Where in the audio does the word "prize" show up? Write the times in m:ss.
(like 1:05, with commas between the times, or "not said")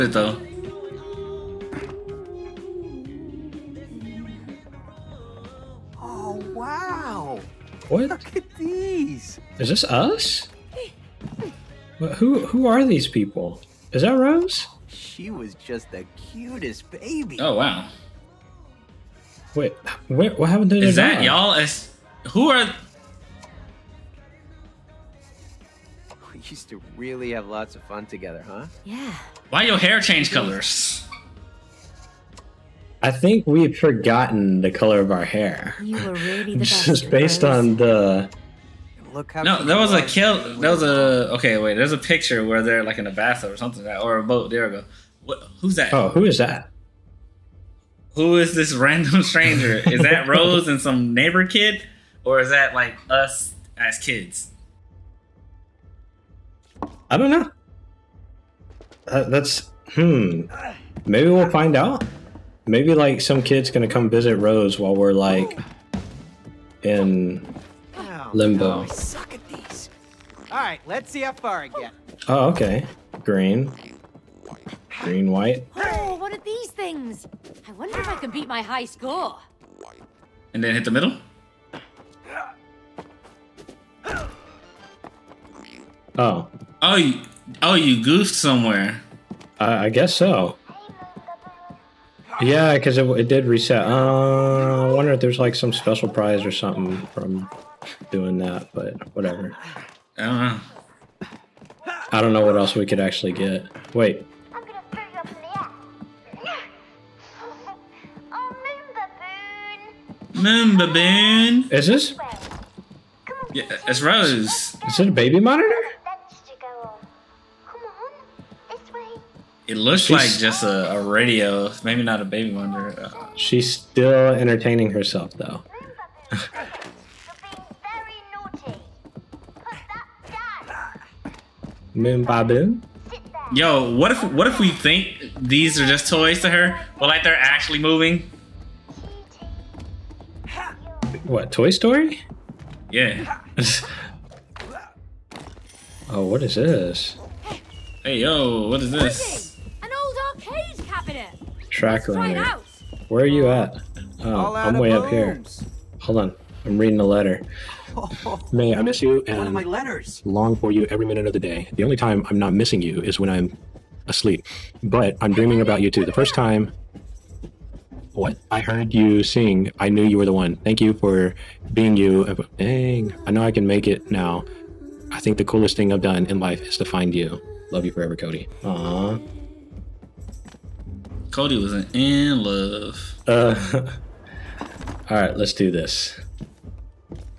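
1:36.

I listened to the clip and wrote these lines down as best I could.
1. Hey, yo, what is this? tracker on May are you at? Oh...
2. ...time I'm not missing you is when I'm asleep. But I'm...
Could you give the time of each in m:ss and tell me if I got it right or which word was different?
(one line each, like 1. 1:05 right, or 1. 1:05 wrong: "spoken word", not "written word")
1. 2:28 wrong: "Where", not "May"
2. 2:41 right.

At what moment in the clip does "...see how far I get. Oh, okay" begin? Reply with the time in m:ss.
1:11.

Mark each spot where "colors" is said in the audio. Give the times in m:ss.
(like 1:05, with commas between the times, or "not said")
0:30, 0:34.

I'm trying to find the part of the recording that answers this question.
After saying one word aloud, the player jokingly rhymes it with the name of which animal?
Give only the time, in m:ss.
1:50.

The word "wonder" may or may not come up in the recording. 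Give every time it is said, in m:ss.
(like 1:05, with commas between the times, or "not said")
1:17, 1:34, 2:02.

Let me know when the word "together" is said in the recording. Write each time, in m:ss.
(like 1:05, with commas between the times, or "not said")
0:28.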